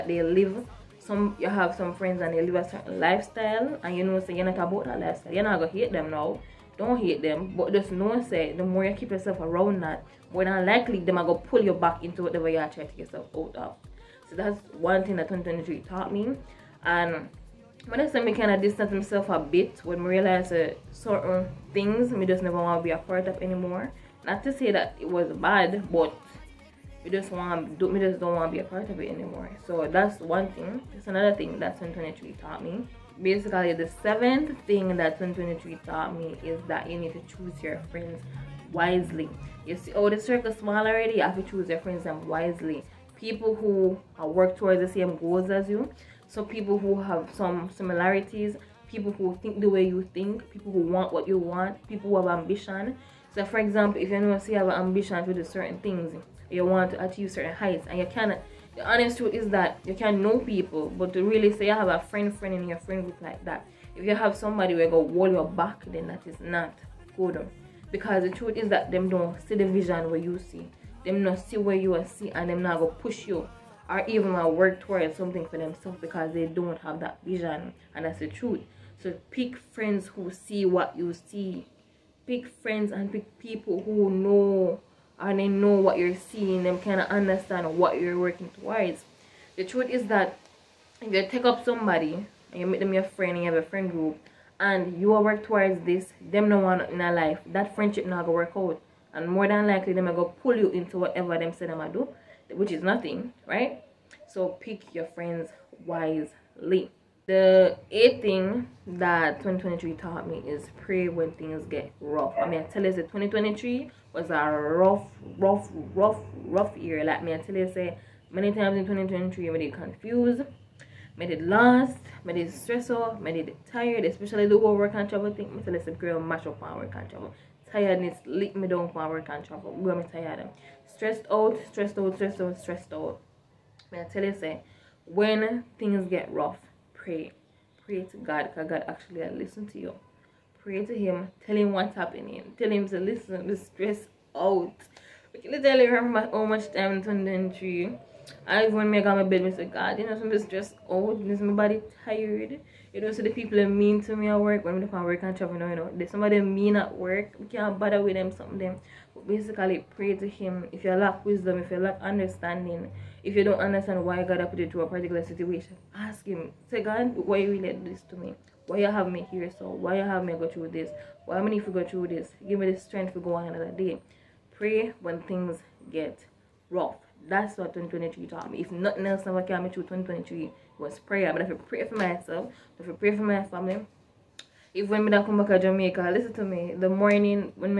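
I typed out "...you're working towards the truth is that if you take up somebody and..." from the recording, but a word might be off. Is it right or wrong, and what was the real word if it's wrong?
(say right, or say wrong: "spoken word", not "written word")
right.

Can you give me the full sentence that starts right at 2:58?
If nothing else never came me through 2023 was prayer.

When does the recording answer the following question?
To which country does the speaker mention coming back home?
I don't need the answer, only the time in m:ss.
3:05.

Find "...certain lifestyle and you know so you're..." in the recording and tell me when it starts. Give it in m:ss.
0:02.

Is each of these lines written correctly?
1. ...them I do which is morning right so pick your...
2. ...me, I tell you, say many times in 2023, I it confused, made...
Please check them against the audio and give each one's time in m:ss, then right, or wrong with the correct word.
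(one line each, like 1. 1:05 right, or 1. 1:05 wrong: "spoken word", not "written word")
1. 1:41 wrong: "nothing", not "morning"
2. 1:57 right.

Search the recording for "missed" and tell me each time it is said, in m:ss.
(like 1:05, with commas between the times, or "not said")
not said.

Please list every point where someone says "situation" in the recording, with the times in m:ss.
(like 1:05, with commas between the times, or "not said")
2:45.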